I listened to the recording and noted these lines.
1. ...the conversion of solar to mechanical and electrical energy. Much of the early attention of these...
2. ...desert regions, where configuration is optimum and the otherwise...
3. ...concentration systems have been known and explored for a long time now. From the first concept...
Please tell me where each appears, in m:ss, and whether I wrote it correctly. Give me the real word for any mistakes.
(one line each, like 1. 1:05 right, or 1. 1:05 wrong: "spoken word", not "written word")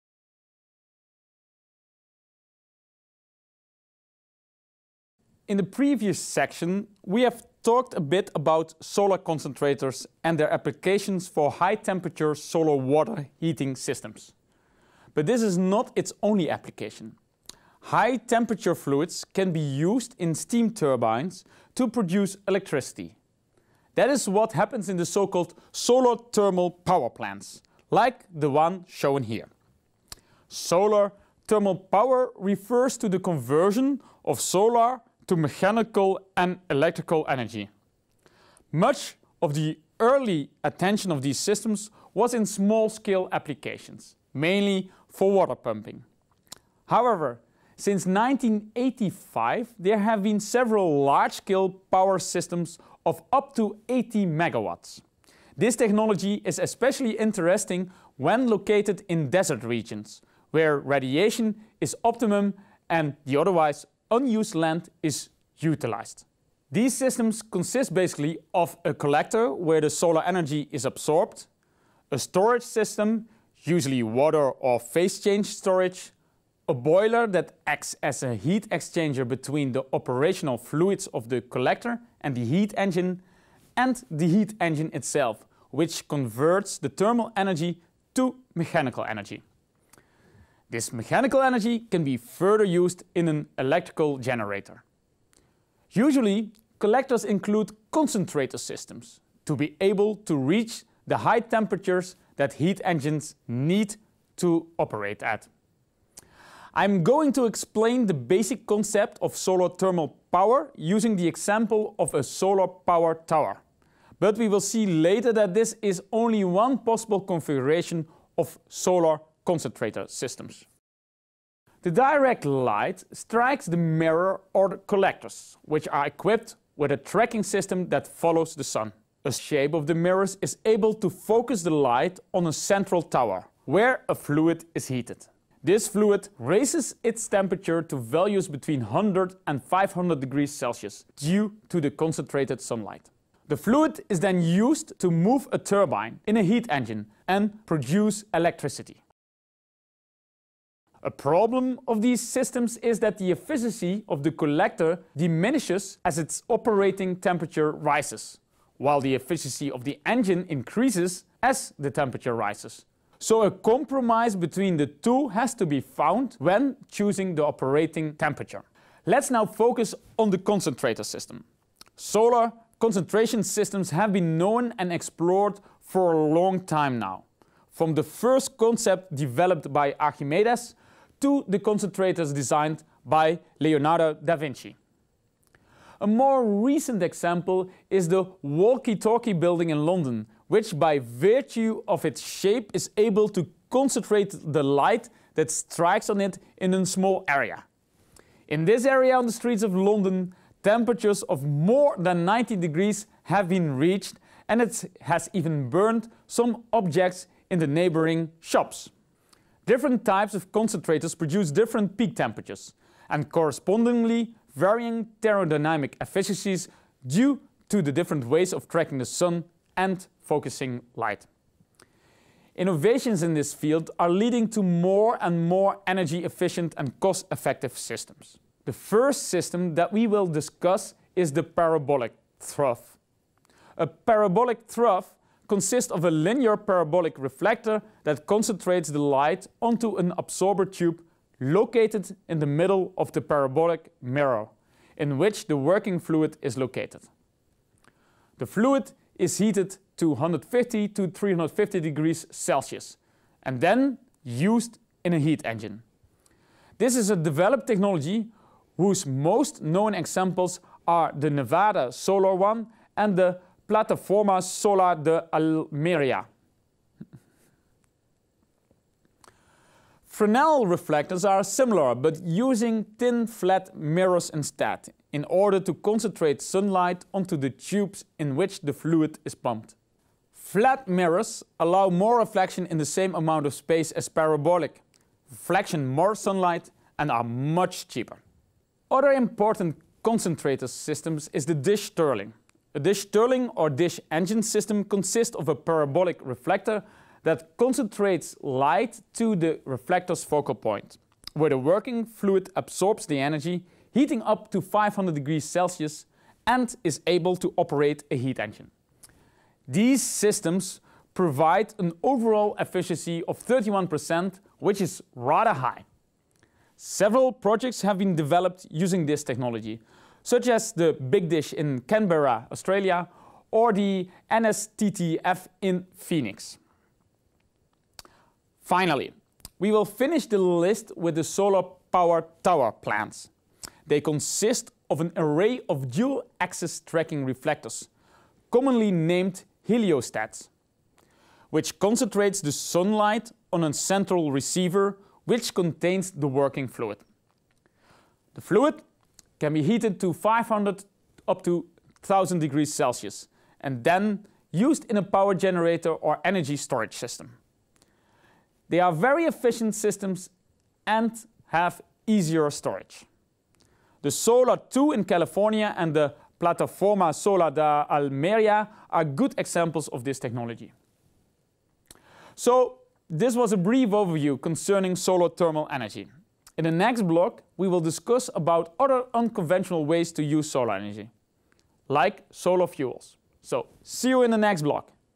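1. 0:33 right
2. 0:59 wrong: "radiation", not "configuration"
3. 2:52 right.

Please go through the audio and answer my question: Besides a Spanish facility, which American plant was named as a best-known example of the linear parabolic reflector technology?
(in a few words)
Nevada Solar One.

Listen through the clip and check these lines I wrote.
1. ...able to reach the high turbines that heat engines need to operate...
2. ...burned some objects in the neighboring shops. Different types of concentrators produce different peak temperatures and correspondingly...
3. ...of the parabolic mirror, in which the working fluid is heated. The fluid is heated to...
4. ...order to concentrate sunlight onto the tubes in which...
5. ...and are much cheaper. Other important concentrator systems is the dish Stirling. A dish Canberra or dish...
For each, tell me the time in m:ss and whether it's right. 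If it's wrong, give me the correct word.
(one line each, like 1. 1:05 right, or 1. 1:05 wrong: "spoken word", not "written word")
1. 1:39 wrong: "temperatures", not "turbines"
2. 3:25 right
3. 4:02 wrong: "located", not "heated"
4. 4:35 right
5. 4:46 wrong: "Stirling", not "Canberra".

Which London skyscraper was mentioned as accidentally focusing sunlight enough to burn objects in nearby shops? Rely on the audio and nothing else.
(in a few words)
Walkie-talkie building.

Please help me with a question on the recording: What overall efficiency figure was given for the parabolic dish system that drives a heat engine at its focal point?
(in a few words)
31%.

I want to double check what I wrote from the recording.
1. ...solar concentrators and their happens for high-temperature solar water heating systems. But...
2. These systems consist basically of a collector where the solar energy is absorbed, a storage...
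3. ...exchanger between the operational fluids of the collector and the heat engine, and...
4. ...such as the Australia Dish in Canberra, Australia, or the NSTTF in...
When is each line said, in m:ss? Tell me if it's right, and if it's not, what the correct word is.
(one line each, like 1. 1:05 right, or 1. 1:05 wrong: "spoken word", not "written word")
1. 0:08 wrong: "applications", not "happens"
2. 1:06 right
3. 1:18 right
4. 5:20 wrong: "Big", not "Australia".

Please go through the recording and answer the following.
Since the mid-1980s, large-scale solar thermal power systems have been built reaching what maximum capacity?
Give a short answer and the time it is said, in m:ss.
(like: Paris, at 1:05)
80 megawatts, at 0:53.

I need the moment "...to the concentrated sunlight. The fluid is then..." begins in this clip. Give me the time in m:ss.
2:21.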